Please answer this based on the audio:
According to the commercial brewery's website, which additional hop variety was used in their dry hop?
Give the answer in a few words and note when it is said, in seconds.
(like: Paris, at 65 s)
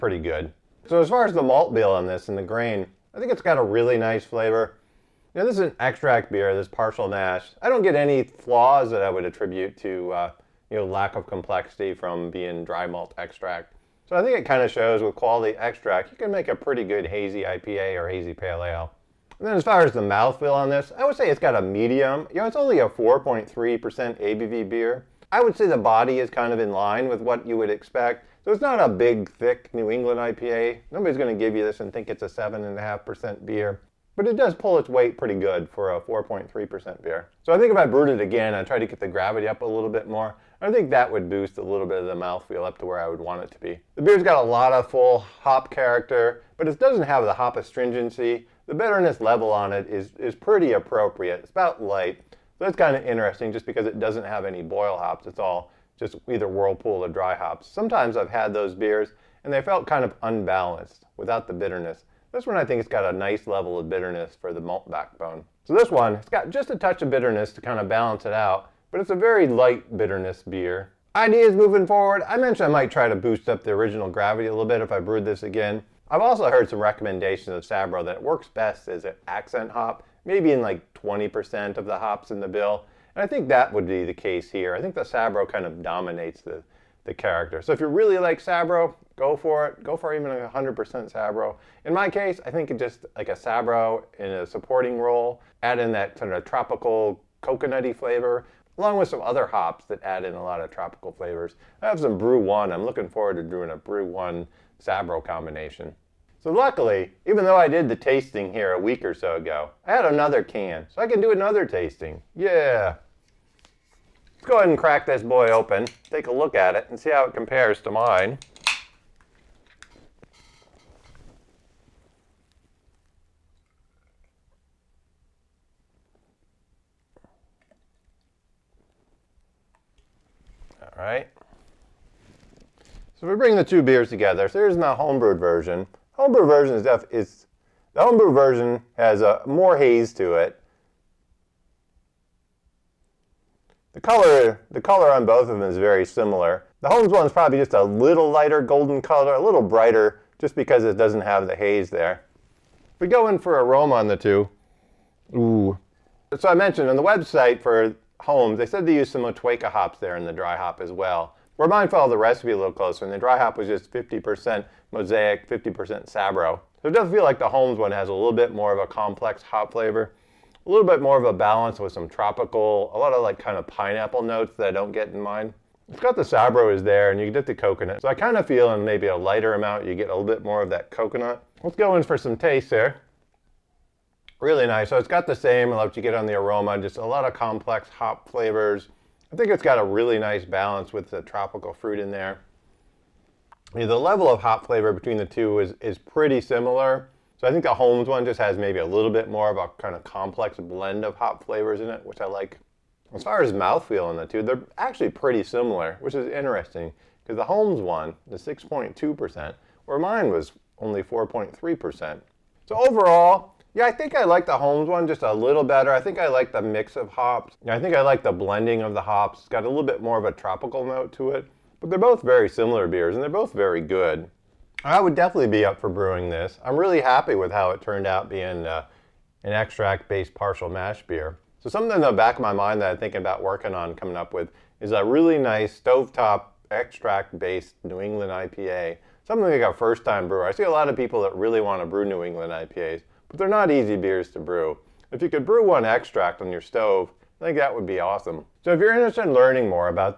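Motueka, at 159 s.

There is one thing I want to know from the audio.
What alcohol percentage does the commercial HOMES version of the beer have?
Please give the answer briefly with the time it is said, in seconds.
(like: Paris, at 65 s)
6.2%, at 208 s.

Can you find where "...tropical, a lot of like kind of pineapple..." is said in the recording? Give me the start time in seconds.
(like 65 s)
172 s.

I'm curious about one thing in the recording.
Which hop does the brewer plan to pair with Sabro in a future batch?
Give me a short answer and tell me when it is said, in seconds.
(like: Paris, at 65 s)
BRU-1, at 102 s.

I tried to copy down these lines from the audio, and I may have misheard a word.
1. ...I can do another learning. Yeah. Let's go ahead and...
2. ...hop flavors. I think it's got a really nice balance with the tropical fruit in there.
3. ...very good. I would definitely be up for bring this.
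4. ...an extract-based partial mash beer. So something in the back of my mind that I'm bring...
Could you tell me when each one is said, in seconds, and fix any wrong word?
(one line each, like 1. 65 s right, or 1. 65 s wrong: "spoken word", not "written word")
1. 111 s wrong: "tasting", not "learning"
2. 187 s right
3. 223 s wrong: "brewing", not "bring"
4. 229 s wrong: "thinking", not "bring".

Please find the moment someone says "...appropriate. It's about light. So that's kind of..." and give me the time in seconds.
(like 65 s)
50 s.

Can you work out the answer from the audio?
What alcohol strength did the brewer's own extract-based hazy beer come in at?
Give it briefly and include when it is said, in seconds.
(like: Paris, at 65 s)
4.3%, at 22 s.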